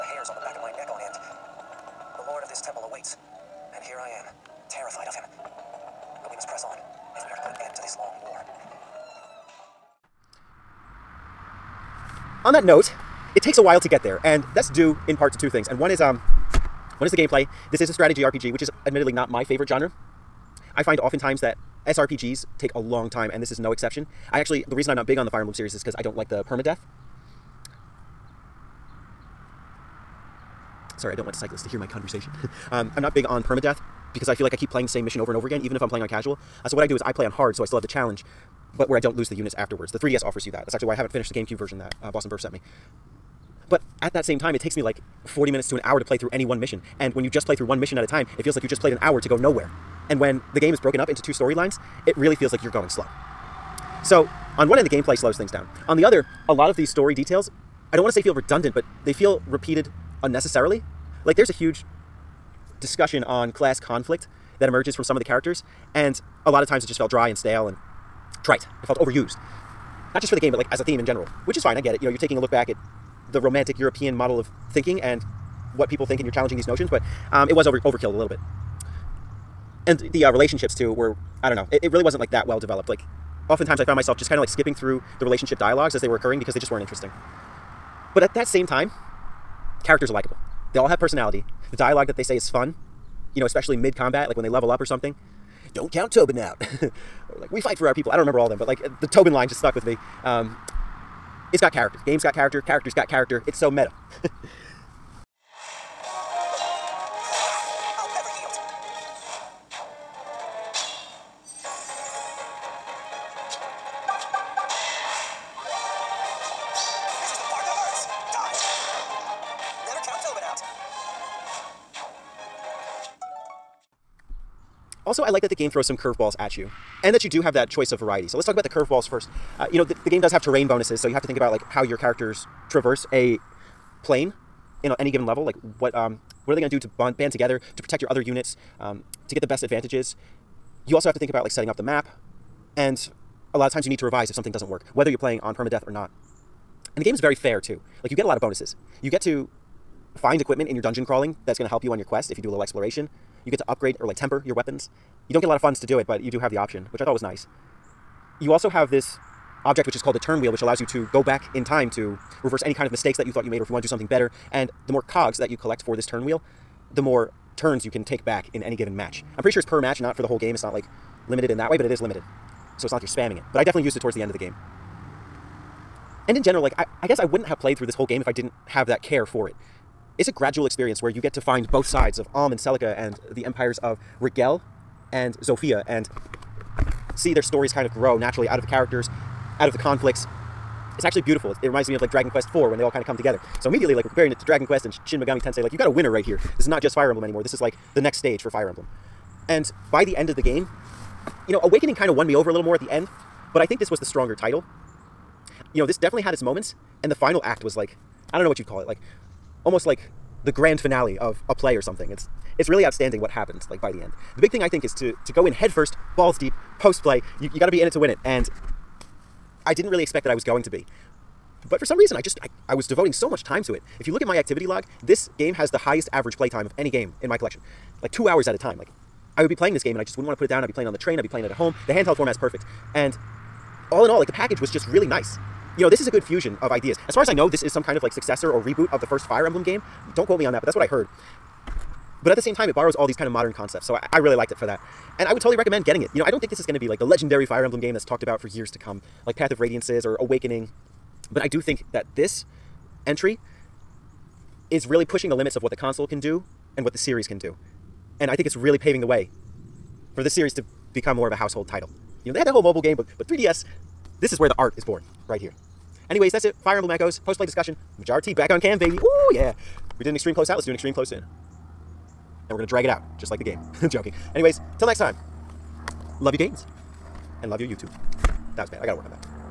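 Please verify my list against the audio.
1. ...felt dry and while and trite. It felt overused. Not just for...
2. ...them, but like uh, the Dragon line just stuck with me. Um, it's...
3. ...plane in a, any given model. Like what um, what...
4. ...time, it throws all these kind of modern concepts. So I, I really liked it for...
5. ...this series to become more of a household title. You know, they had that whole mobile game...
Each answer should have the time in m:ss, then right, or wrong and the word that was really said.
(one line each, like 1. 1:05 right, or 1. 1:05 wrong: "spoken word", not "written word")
1. 1:06 wrong: "stale", not "while"
2. 1:38 wrong: "Tobin", not "Dragon"
3. 2:14 wrong: "level", not "model"
4. 4:02 wrong: "borrows", not "throws"
5. 4:20 right.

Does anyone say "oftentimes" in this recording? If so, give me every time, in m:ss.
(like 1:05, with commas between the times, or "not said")
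0:20, 1:23.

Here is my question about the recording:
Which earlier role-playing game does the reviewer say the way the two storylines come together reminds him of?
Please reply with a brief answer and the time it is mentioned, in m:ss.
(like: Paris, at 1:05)
Dragon Quest IV, at 3:12.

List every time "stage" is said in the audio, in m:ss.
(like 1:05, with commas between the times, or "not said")
3:18.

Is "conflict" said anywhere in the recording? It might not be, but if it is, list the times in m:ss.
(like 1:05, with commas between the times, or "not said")
1:03, 3:09.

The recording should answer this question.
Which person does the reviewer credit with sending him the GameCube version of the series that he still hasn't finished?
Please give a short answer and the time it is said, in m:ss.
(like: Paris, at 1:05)
Boston Burr, at 0:42.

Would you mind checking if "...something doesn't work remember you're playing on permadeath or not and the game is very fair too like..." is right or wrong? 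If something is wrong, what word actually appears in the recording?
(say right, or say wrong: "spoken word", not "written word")
wrong: "whether", not "remember".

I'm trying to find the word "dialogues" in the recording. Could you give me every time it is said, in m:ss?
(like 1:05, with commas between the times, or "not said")
1:25, 1:31.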